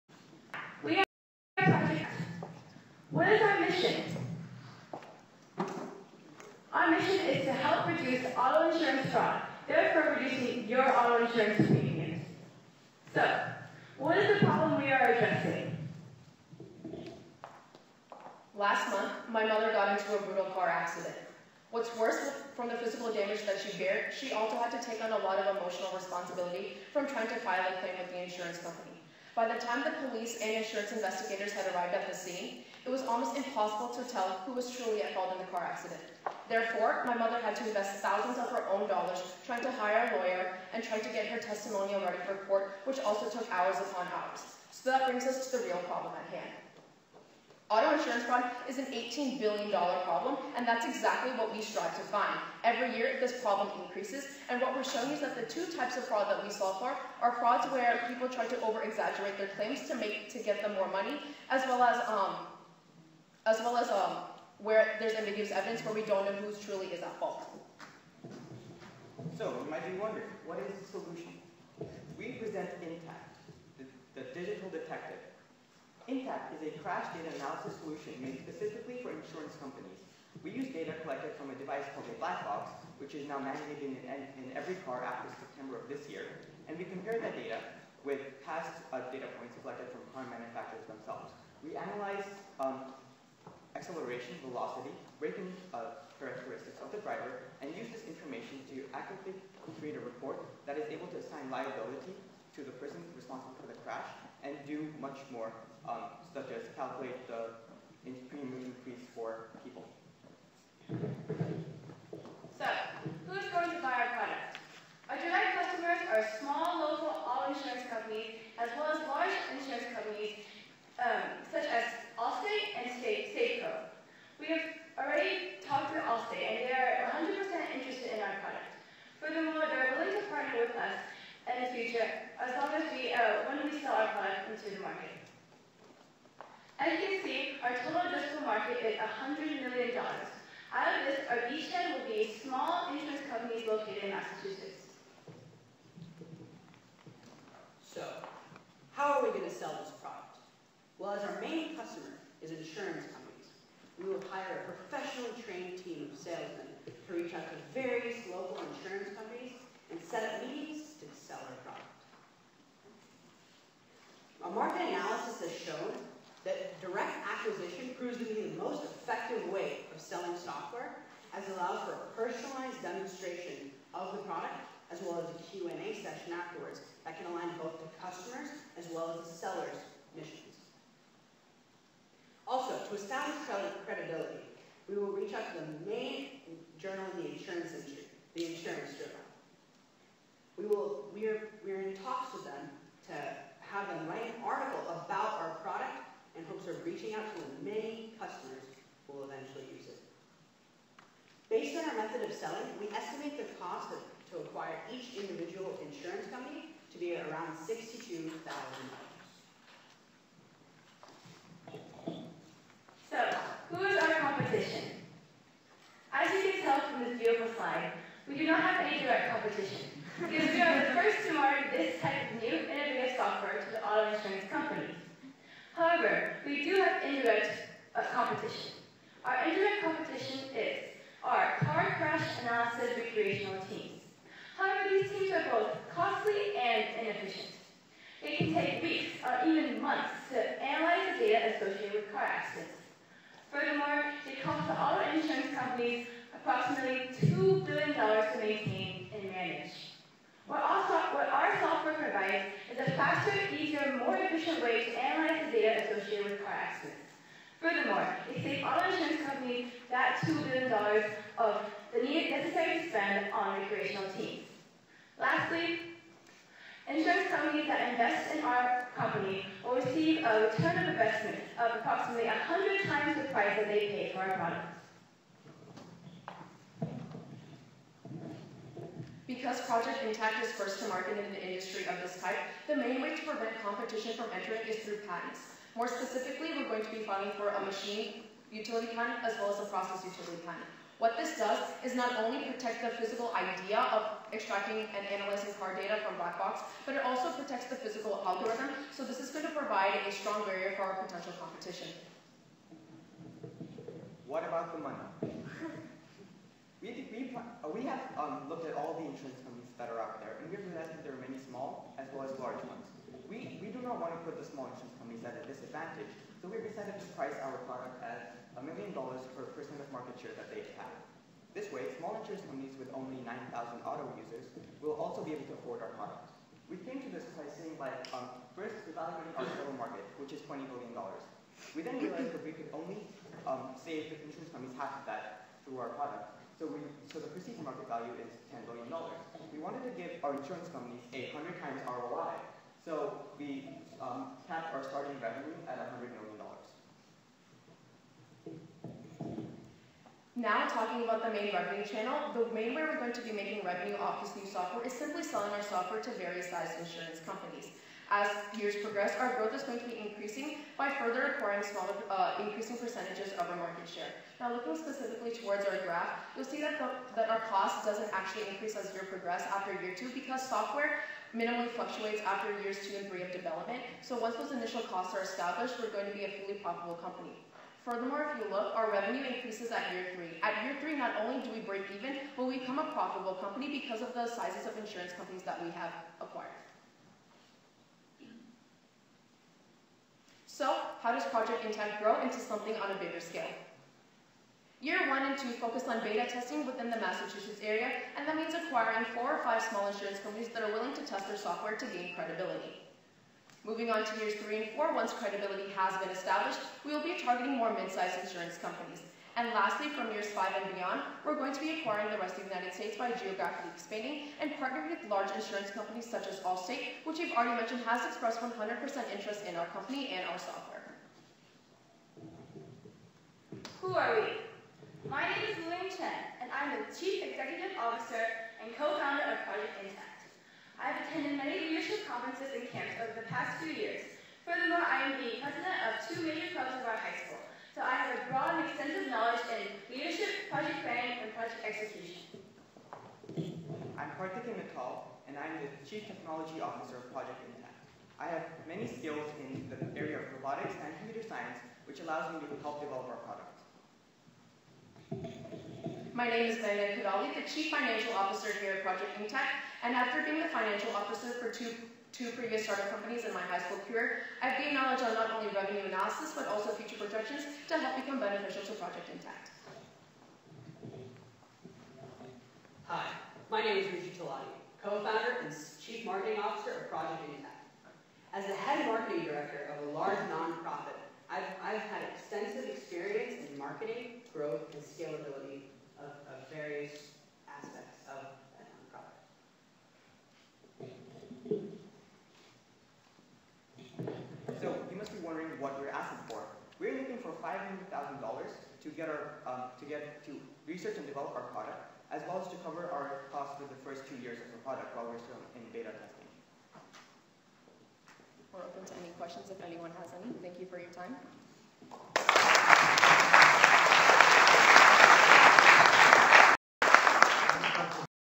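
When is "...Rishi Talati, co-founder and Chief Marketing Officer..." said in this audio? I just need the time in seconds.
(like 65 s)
473 s.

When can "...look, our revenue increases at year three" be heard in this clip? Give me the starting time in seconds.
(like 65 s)
378 s.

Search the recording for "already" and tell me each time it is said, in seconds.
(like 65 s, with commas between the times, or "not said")
124 s, 417 s.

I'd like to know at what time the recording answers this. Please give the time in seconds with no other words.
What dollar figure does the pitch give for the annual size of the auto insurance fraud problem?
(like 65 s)
48 s.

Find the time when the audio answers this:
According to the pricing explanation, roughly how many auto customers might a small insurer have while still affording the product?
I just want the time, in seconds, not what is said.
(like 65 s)
323 s.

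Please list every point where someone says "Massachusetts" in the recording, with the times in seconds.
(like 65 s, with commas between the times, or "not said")
144 s, 396 s.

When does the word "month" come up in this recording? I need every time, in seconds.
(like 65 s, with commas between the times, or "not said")
18 s, 239 s.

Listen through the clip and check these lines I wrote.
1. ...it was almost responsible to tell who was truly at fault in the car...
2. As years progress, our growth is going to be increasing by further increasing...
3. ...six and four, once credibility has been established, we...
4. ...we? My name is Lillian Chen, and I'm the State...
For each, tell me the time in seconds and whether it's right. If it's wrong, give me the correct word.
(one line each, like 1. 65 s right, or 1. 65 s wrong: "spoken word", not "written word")
1. 32 s wrong: "impossible", not "responsible"
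2. 358 s wrong: "acquiring", not "increasing"
3. 404 s wrong: "three", not "six"
4. 424 s wrong: "Chief", not "State".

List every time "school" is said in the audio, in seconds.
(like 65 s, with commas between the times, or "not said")
437 s, 463 s.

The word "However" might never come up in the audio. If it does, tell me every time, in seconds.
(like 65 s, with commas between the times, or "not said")
225 s, 234 s.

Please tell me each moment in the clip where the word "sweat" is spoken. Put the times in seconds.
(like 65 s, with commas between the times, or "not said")
not said.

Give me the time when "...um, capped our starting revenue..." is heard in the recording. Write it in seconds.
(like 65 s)
343 s.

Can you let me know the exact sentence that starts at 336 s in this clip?
So, we, so the perceived market value is $10 billion.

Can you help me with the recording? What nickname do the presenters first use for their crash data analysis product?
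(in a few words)
the digital detective.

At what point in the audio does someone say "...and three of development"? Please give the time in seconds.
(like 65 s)
372 s.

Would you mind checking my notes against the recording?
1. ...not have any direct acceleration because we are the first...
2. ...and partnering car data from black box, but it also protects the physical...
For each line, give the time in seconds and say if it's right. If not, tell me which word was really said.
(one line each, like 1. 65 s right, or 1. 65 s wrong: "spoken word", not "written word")
1. 218 s wrong: "competition", not "acceleration"
2. 294 s wrong: "analyzing", not "partnering".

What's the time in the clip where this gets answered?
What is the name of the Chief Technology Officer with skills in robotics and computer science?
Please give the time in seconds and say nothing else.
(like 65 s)
444 s.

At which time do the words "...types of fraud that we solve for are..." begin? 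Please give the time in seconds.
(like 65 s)
55 s.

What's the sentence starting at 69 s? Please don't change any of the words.
So, you might be wondering, what is the solution?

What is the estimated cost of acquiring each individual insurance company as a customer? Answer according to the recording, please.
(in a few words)
$62,000.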